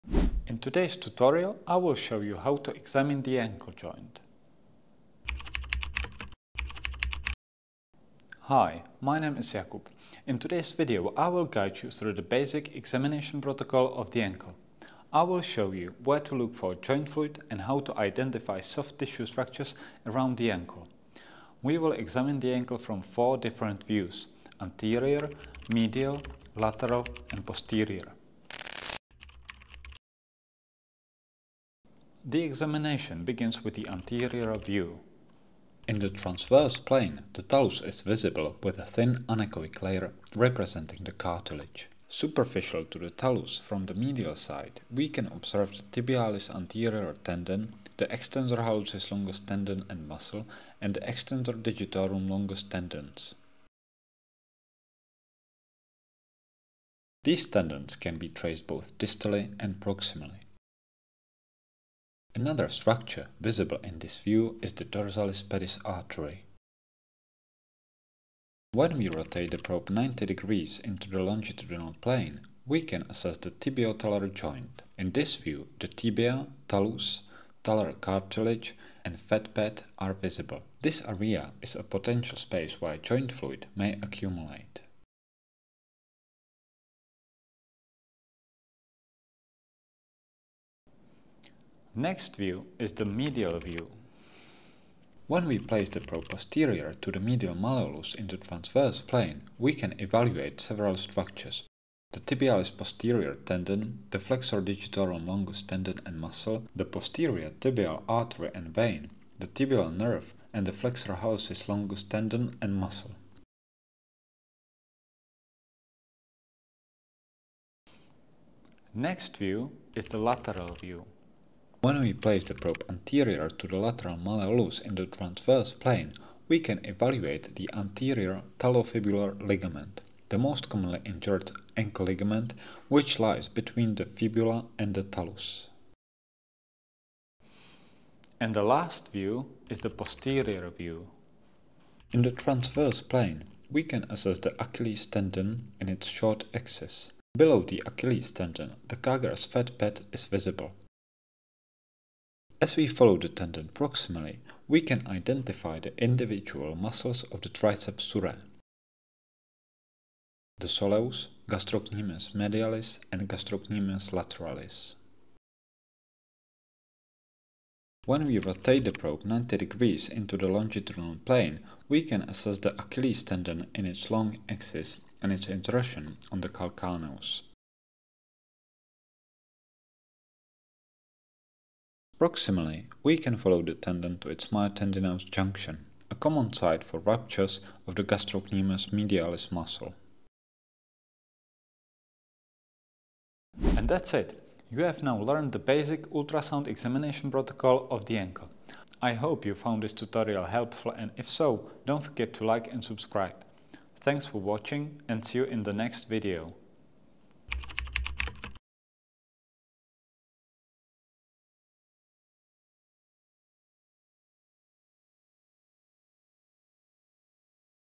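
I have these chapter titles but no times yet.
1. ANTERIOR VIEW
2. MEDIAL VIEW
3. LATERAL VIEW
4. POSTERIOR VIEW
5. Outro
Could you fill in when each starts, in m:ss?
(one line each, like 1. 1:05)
1. 0:32
2. 1:31
3. 1:58
4. 2:17
5. 3:13.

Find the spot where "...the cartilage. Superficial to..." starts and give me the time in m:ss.
0:41.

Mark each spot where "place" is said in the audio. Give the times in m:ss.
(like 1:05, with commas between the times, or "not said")
1:35, 2:02.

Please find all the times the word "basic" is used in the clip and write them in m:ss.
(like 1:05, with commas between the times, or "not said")
0:12, 3:15.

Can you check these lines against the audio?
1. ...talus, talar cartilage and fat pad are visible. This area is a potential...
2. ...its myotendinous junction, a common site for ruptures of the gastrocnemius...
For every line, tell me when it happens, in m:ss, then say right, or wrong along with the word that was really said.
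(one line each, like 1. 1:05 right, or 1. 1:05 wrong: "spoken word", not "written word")
1. 1:16 right
2. 3:04 right.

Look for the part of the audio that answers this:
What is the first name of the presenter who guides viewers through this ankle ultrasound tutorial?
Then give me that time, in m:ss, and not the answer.
0:09.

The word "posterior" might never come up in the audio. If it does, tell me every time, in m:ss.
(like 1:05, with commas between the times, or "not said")
0:27, 1:36, 1:42, 1:46, 2:19.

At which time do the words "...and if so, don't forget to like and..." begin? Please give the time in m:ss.
3:20.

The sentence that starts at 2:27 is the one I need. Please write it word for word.
Below the Achilles tendon, the Kager's fat pad is visible.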